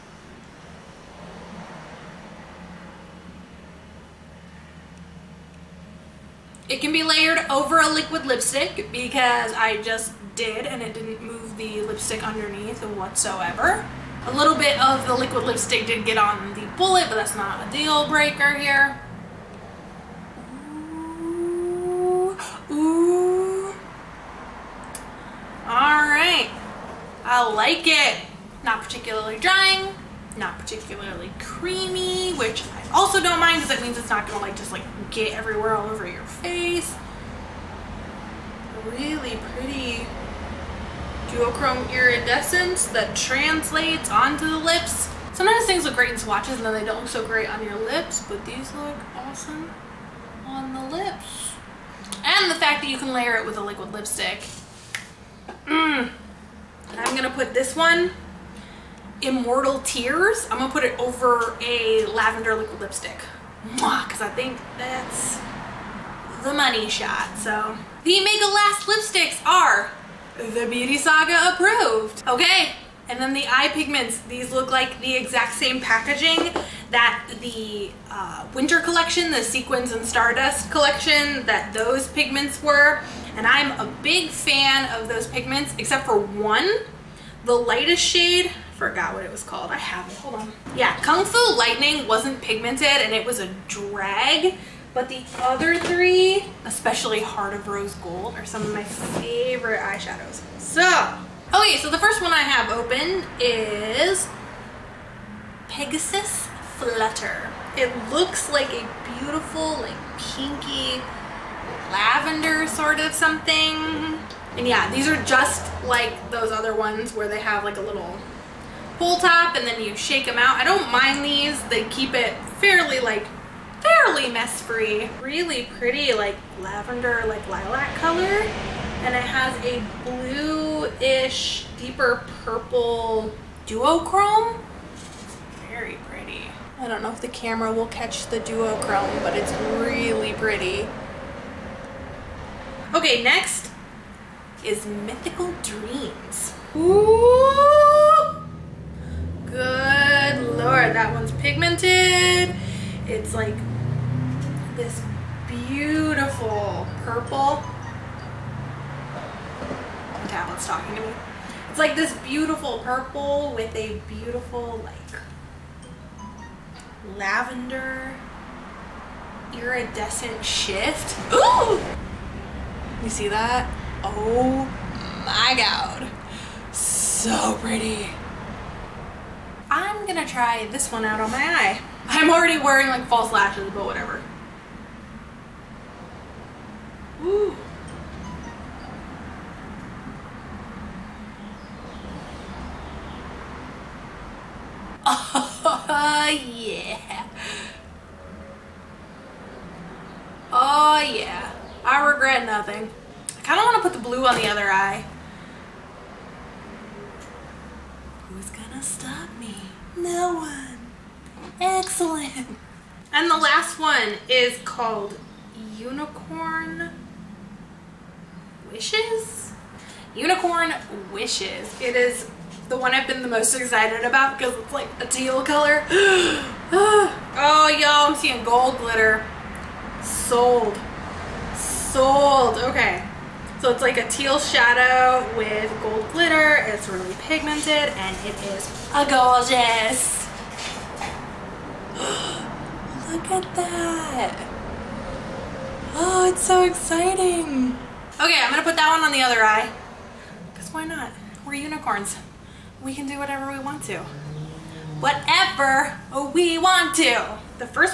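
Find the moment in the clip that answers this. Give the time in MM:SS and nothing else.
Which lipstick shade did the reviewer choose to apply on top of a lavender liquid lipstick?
00:59.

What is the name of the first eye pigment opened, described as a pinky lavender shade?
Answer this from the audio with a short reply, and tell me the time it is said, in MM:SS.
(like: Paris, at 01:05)
Pegasus Flutter, at 01:45.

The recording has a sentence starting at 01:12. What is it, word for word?
Okay, and then the eye pigments.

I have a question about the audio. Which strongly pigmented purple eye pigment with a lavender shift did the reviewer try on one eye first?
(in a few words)
Mythical Dreams.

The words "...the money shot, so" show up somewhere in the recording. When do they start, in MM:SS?
01:06.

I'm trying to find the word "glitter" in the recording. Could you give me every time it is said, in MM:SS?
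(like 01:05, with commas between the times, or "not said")
03:48, 03:56.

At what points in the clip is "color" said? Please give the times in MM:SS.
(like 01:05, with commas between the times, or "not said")
02:07, 03:45.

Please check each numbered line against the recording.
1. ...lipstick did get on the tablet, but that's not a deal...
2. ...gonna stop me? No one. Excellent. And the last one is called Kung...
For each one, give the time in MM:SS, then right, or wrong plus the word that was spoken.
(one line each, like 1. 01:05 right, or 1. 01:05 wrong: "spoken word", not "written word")
1. 00:15 wrong: "bullet", not "tablet"
2. 03:28 wrong: "Unicorn", not "Kung".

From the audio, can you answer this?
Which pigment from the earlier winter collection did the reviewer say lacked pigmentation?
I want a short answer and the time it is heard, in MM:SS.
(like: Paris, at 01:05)
Kung Fu Lightning, at 01:31.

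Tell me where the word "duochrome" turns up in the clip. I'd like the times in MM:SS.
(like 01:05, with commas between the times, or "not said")
00:41, 02:13, 02:18.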